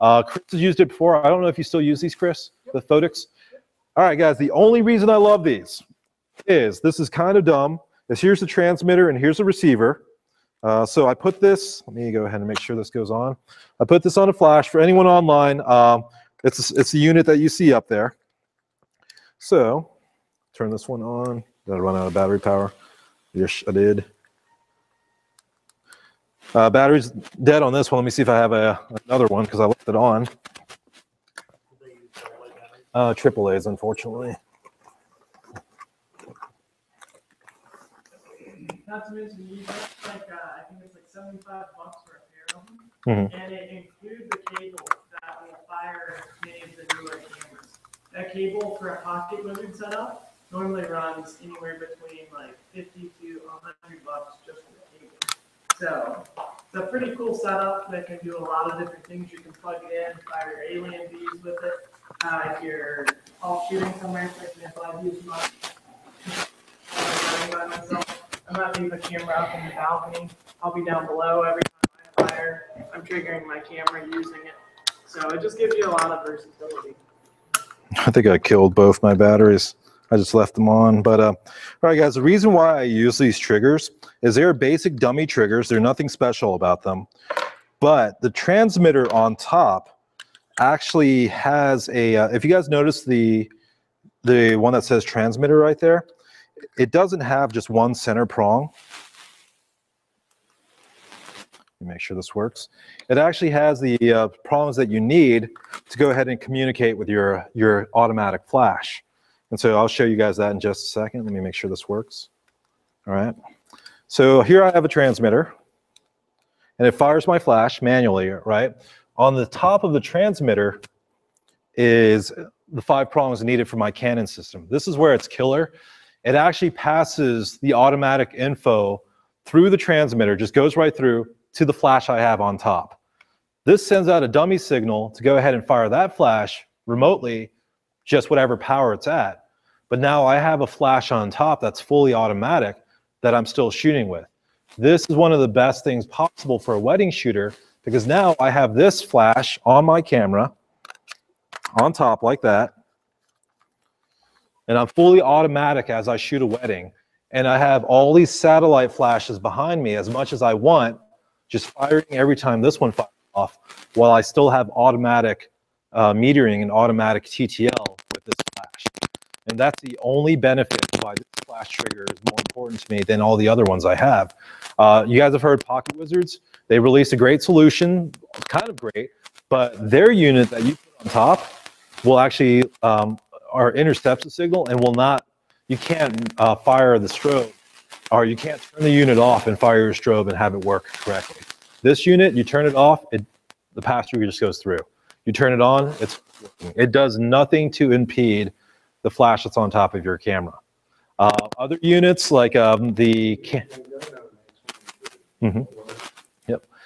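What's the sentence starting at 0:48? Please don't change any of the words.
That cable for a PocketWizard setup normally runs anywhere between like 50 to 100 bucks just for the cable.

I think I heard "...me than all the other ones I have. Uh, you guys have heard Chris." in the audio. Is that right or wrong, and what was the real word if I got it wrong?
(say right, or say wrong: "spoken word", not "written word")
wrong: "PocketWizards", not "Chris".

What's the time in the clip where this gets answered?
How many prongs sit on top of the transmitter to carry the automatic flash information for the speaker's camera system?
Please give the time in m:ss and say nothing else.
2:02.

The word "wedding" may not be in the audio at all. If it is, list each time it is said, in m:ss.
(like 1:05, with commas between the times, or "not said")
2:26, 2:36.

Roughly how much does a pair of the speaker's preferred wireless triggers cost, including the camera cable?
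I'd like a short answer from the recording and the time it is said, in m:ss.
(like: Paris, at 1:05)
$75, at 0:41.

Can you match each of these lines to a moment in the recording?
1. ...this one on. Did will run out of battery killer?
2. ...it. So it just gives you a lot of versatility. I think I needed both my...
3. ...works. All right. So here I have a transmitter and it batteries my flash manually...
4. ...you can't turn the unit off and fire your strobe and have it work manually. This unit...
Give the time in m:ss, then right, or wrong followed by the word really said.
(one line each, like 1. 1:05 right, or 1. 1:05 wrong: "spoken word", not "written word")
1. 0:20 wrong: "power", not "killer"
2. 1:14 wrong: "killed", not "needed"
3. 1:51 wrong: "fires", not "batteries"
4. 3:08 wrong: "correctly", not "manually".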